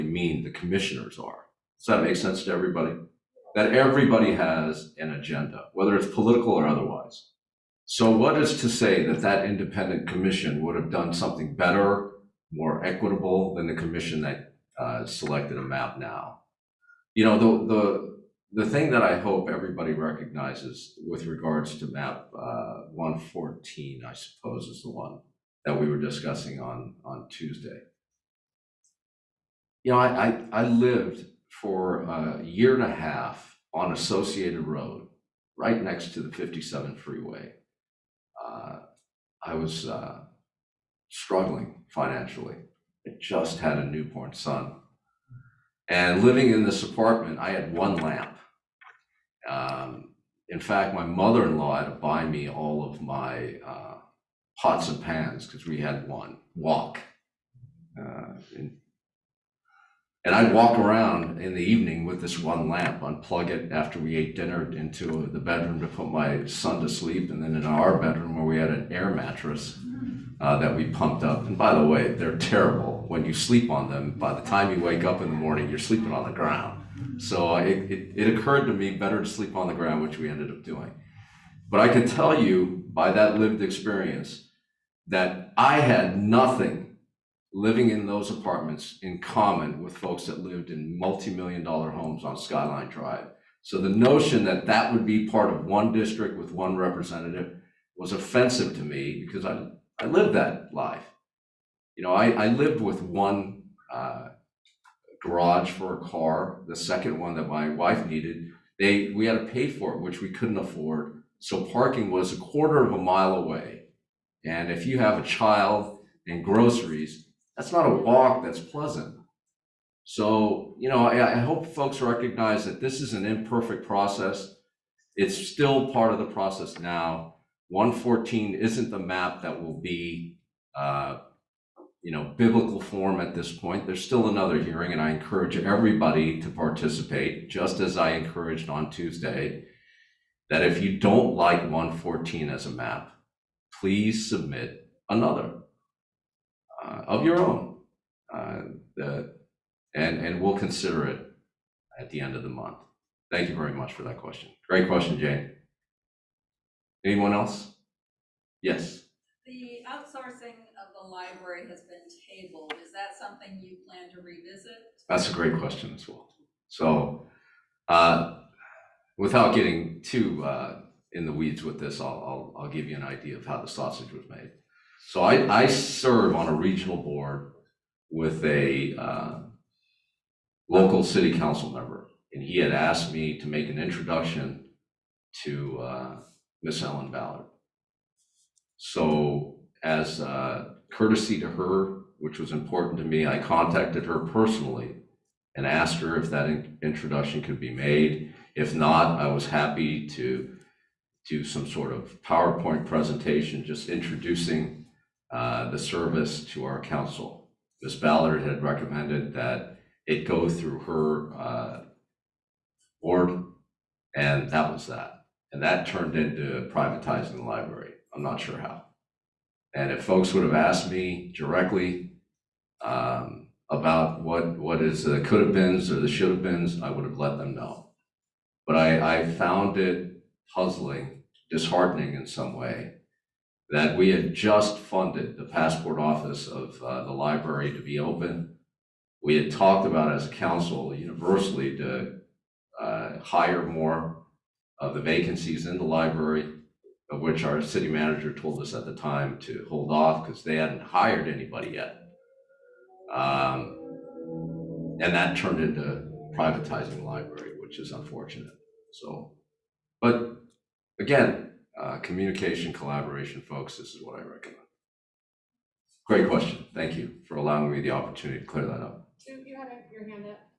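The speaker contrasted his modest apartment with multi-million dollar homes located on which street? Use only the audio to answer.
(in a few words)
Skyline Drive.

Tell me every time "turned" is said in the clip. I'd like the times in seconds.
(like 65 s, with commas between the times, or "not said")
215 s, 255 s.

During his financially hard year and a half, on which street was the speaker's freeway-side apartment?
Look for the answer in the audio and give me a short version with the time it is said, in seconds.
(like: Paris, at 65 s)
Associated Road, at 33 s.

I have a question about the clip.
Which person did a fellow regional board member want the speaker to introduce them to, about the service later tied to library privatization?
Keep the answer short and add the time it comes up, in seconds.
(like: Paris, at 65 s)
Ellen Ballard, at 186 s.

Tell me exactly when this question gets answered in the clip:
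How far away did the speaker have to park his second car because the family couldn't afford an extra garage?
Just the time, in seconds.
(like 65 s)
112 s.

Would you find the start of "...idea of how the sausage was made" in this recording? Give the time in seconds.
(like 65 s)
173 s.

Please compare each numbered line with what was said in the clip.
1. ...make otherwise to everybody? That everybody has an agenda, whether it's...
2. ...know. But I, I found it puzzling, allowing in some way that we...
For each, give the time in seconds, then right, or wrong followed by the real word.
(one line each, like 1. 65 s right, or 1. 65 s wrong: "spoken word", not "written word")
1. 2 s wrong: "sense", not "otherwise"
2. 227 s wrong: "disheartening", not "allowing".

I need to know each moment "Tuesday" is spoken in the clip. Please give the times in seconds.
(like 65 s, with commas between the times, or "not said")
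27 s, 138 s.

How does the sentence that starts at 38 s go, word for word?
Uh, I was uh, struggling financially.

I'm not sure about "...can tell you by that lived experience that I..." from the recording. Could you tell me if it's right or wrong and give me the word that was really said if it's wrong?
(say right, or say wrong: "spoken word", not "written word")
right.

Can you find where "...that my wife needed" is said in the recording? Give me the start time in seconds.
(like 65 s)
107 s.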